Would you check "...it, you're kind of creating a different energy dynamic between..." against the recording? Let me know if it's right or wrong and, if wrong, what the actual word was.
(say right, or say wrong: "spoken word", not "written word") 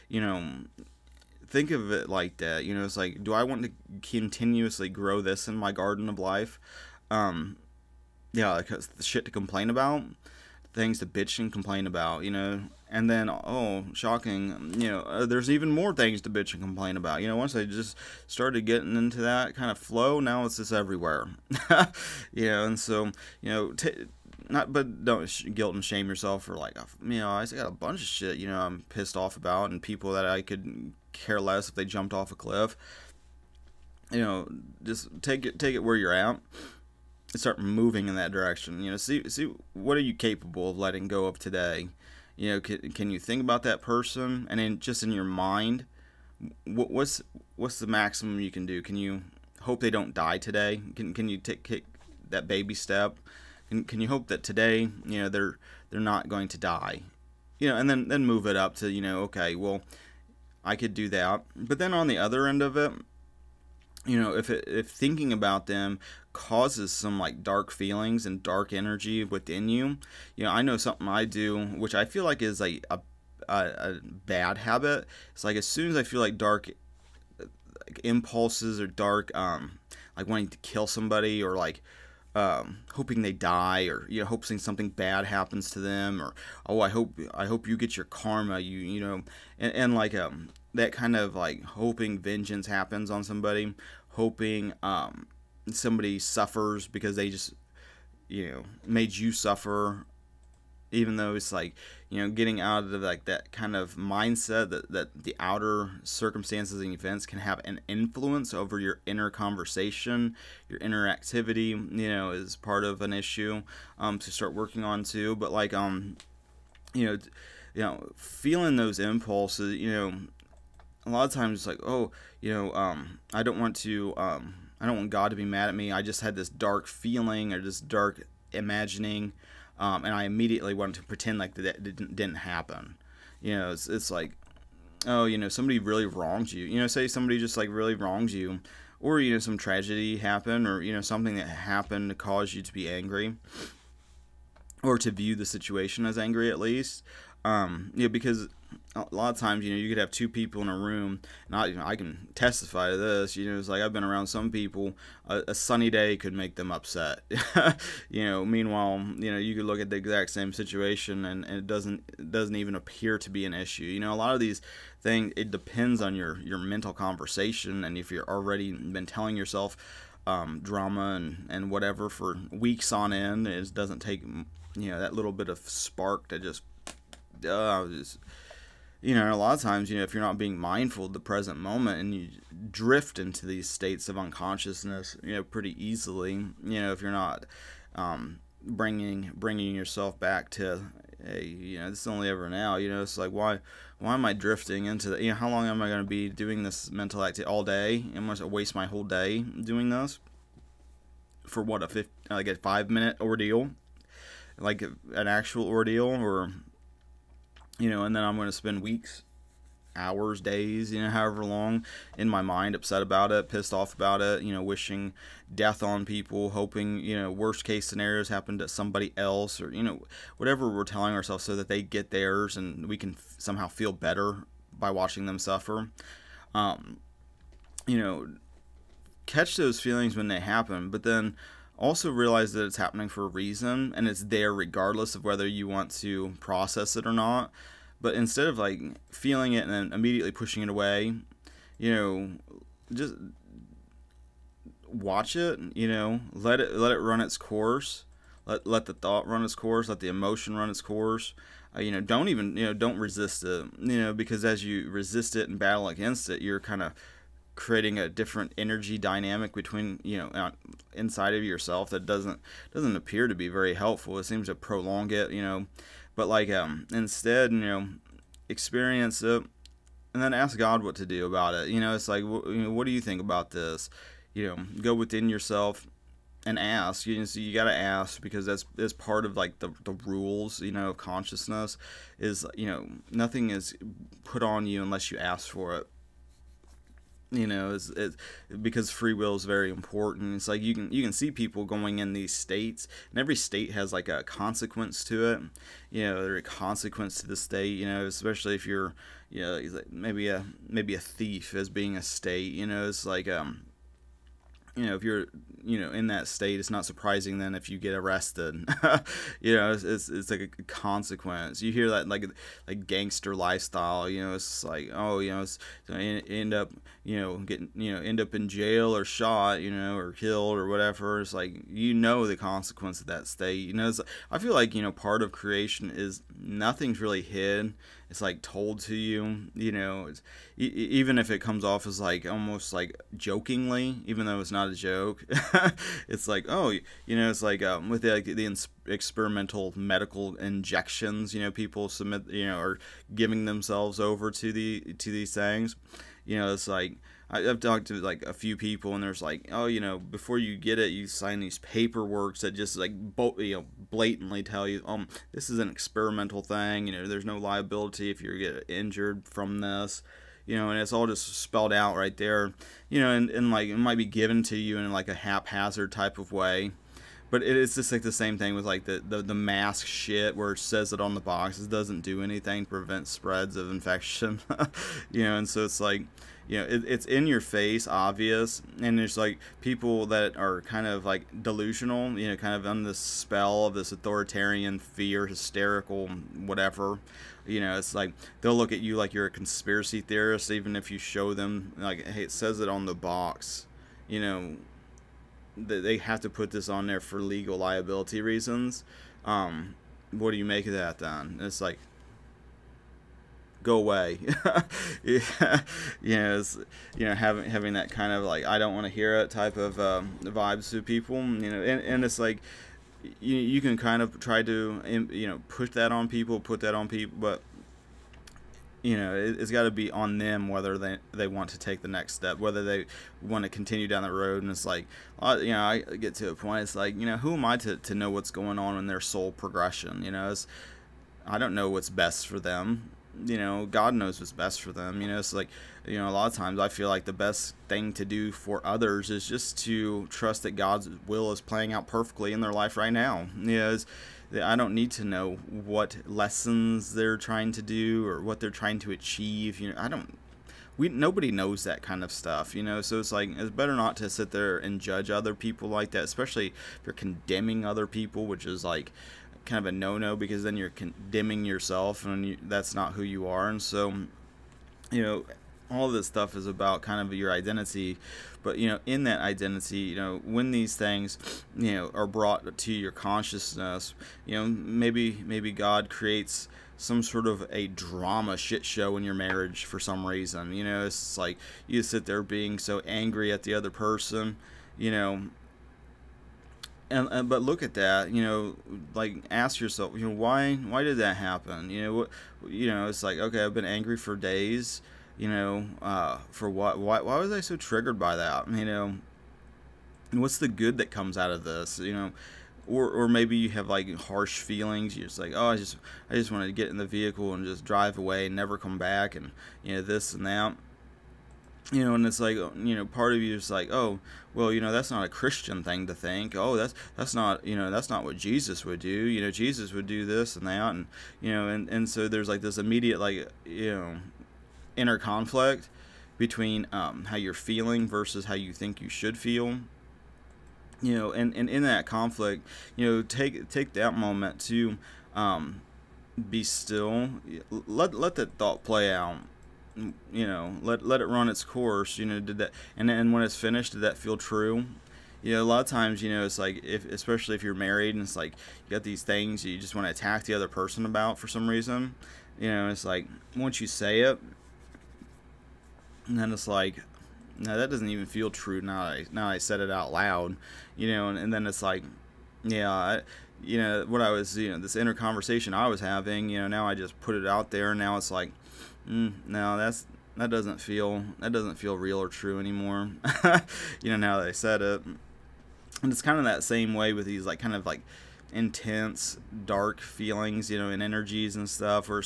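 right.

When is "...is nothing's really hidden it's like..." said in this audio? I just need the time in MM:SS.
05:25.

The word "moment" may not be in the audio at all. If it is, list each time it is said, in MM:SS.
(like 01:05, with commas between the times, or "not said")
03:01, 08:53.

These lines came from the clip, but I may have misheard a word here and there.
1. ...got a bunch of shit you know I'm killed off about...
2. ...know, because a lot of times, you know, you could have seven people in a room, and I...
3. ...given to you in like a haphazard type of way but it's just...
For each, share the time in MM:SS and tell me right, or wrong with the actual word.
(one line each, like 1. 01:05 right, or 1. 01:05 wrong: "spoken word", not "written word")
1. 00:27 wrong: "pissed", not "killed"
2. 02:28 wrong: "two", not "seven"
3. 06:04 right.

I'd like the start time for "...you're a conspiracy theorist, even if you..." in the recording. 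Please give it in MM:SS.
06:29.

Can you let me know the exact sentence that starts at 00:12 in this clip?
And then, oh, shocking, you know, uh, there's even more things to bitch and complain about.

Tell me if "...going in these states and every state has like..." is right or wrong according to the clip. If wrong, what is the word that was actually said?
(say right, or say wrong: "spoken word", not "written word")
right.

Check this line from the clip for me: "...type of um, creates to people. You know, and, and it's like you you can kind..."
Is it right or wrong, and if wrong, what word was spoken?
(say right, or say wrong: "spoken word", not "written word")
wrong: "vibes", not "creates".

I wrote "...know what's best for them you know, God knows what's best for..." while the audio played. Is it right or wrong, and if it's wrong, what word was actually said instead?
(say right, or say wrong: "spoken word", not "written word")
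right.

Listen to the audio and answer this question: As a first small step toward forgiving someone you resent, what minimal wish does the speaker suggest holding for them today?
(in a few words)
they don't die today.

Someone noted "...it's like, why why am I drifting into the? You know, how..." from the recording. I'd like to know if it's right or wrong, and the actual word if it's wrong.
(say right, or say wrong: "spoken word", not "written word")
right.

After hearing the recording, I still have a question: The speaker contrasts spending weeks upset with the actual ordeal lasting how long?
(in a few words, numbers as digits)
5 minutes.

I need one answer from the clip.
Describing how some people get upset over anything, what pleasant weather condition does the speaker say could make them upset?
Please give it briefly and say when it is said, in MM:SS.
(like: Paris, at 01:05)
a sunny day, at 02:35.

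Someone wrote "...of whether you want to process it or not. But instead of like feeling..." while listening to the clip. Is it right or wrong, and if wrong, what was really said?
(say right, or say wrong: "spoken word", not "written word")
right.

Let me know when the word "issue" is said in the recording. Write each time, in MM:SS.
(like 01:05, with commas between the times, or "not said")
01:53, 02:43.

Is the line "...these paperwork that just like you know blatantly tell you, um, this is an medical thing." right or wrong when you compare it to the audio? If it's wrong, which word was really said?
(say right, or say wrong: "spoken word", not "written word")
wrong: "experimental", not "medical".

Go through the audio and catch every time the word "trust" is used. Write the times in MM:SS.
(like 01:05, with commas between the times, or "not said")
07:20.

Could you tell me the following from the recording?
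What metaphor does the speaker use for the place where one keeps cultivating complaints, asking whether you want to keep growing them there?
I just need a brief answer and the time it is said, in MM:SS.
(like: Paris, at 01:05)
garden of life, at 00:05.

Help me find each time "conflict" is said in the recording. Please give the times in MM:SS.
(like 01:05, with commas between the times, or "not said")
08:44, 08:51.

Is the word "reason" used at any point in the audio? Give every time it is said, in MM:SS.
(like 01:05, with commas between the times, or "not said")
03:53, 06:38, 08:00, 09:11.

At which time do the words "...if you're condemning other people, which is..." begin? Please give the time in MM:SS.
07:36.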